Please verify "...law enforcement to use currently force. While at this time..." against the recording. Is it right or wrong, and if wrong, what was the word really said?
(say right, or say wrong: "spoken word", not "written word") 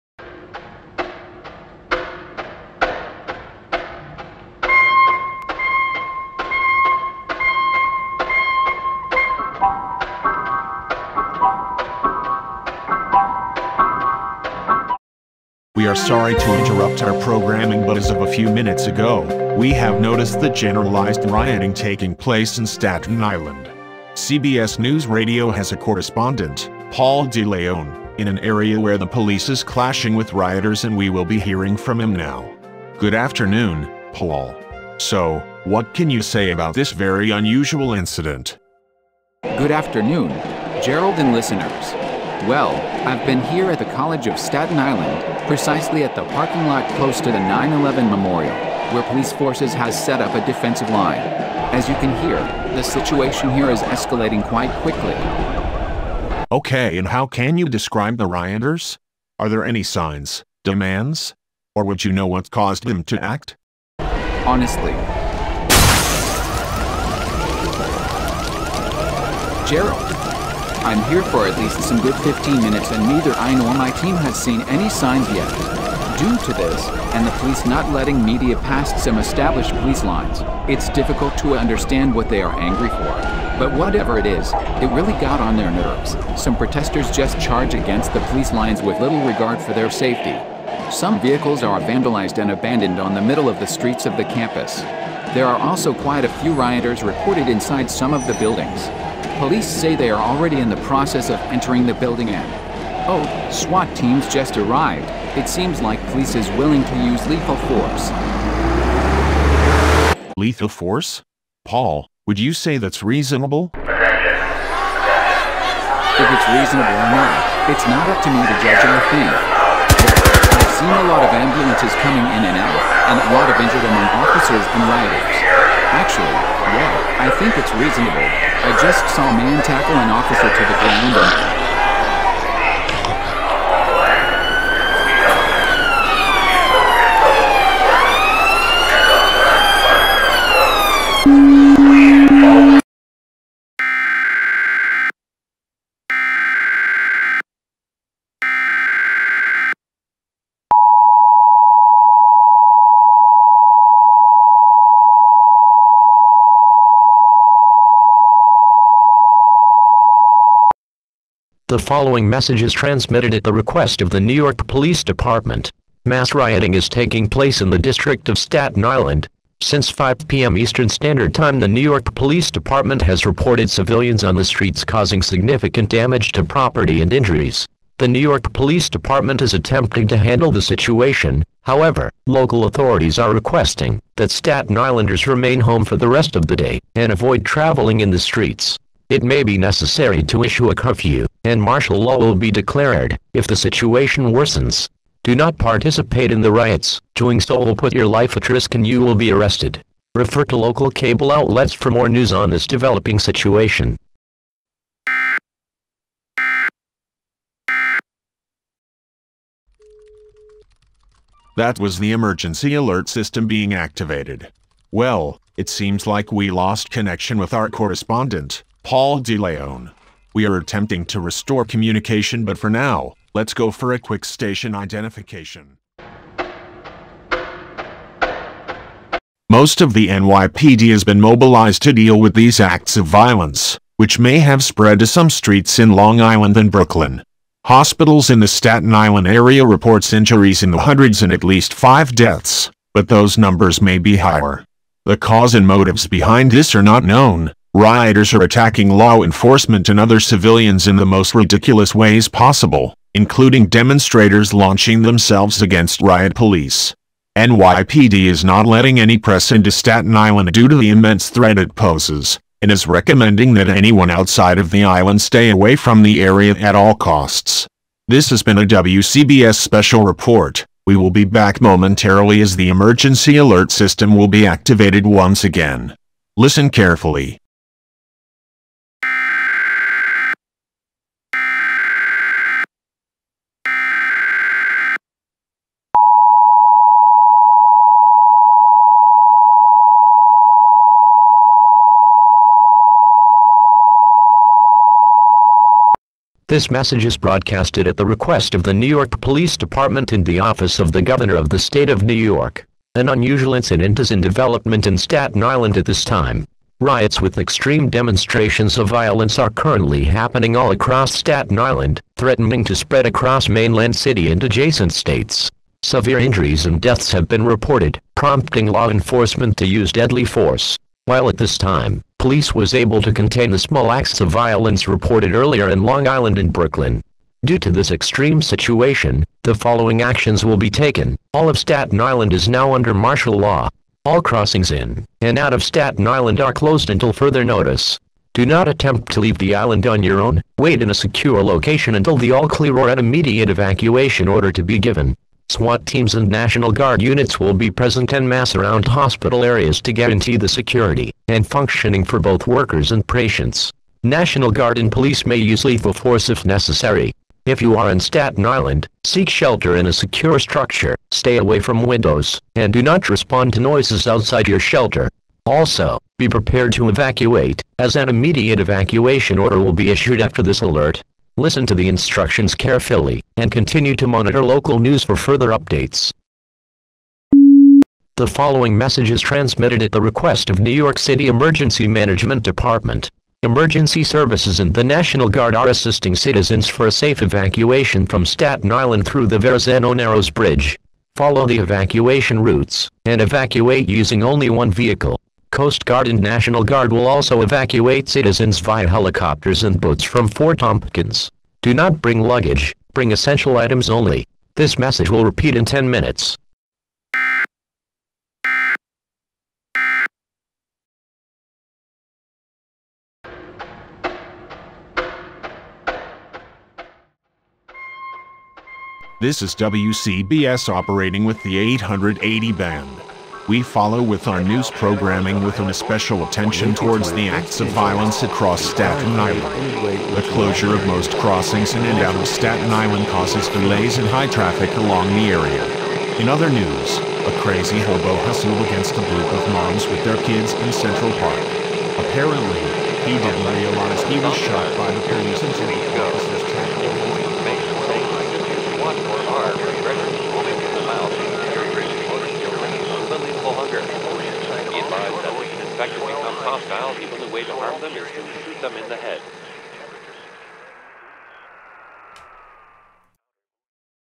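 wrong: "deadly", not "currently".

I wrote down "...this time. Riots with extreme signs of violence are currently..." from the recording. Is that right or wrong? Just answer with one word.
wrong.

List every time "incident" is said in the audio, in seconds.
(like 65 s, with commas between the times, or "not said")
37 s, 303 s.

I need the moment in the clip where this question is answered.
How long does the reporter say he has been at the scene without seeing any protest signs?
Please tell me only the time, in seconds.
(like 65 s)
72 s.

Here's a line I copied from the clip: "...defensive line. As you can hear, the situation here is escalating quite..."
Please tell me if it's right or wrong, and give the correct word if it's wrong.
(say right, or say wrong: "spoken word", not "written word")
right.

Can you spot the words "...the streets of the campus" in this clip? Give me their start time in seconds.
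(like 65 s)
93 s.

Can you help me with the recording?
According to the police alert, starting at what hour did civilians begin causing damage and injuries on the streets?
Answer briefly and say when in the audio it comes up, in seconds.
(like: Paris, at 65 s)
5 p.m., at 169 s.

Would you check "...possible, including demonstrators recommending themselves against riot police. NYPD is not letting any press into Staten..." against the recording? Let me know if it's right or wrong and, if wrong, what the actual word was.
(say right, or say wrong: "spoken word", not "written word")
wrong: "launching", not "recommending".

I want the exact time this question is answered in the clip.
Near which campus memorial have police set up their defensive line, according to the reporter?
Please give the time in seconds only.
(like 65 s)
47 s.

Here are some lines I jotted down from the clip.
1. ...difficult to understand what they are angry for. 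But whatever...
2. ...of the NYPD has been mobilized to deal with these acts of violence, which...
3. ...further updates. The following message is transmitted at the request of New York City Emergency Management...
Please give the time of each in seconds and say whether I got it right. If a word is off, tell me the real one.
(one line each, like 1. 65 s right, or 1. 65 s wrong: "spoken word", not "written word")
1. 80 s right
2. 229 s right
3. 375 s right.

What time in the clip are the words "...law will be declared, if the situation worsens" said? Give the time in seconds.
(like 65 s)
191 s.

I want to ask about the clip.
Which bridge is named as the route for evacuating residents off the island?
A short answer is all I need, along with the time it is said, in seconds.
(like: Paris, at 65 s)
Verrazano Narrows Bridge, at 389 s.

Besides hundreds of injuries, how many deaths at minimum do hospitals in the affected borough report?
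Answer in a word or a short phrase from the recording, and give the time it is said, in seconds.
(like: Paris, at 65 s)
5, at 241 s.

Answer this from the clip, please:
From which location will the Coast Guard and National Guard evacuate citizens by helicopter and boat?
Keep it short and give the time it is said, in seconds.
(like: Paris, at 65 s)
Fort Tompkins, at 400 s.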